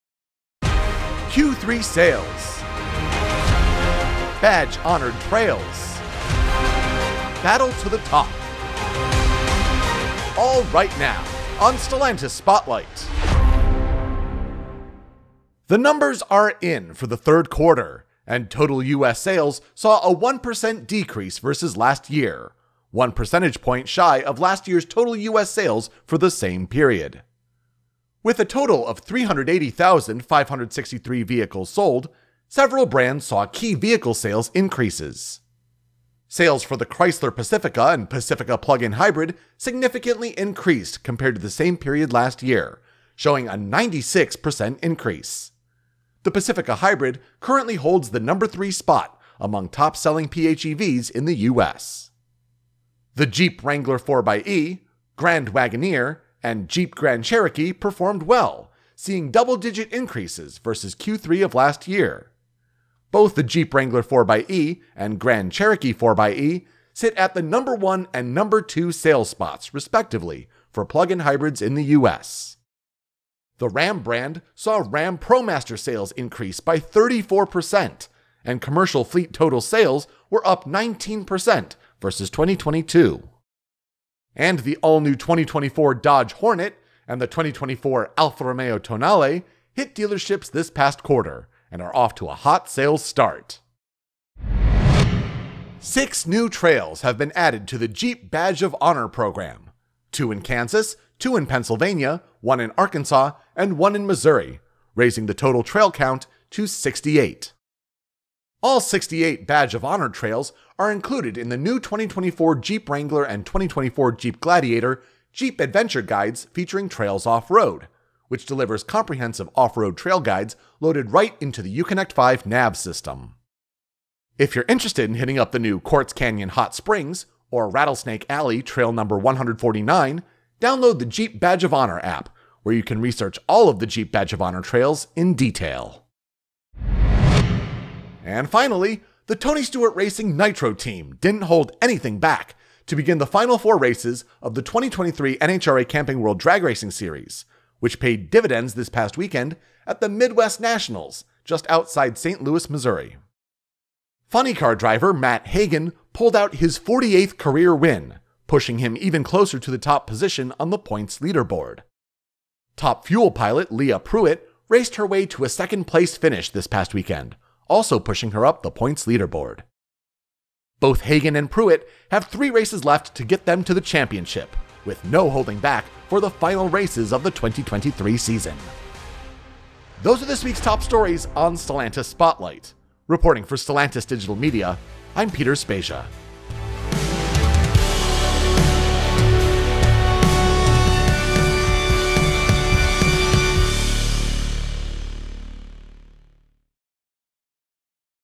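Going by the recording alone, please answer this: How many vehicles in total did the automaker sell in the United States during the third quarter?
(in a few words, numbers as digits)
380,563.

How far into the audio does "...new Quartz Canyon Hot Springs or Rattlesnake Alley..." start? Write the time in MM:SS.
02:05.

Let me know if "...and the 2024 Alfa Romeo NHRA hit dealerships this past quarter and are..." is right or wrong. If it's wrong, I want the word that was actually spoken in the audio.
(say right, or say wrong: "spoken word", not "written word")
wrong: "Tonale", not "NHRA".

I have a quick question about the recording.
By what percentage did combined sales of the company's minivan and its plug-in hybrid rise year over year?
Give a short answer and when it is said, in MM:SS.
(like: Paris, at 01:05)
96%, at 00:43.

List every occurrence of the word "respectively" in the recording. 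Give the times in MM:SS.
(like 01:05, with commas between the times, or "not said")
01:09.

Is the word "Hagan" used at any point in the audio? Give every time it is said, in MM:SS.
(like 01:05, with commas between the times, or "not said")
02:35, 02:51.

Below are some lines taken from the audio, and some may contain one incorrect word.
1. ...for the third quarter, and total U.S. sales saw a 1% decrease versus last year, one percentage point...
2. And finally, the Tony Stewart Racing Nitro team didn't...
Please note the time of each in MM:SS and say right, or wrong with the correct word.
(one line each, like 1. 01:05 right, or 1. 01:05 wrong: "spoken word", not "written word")
1. 00:16 right
2. 02:18 right.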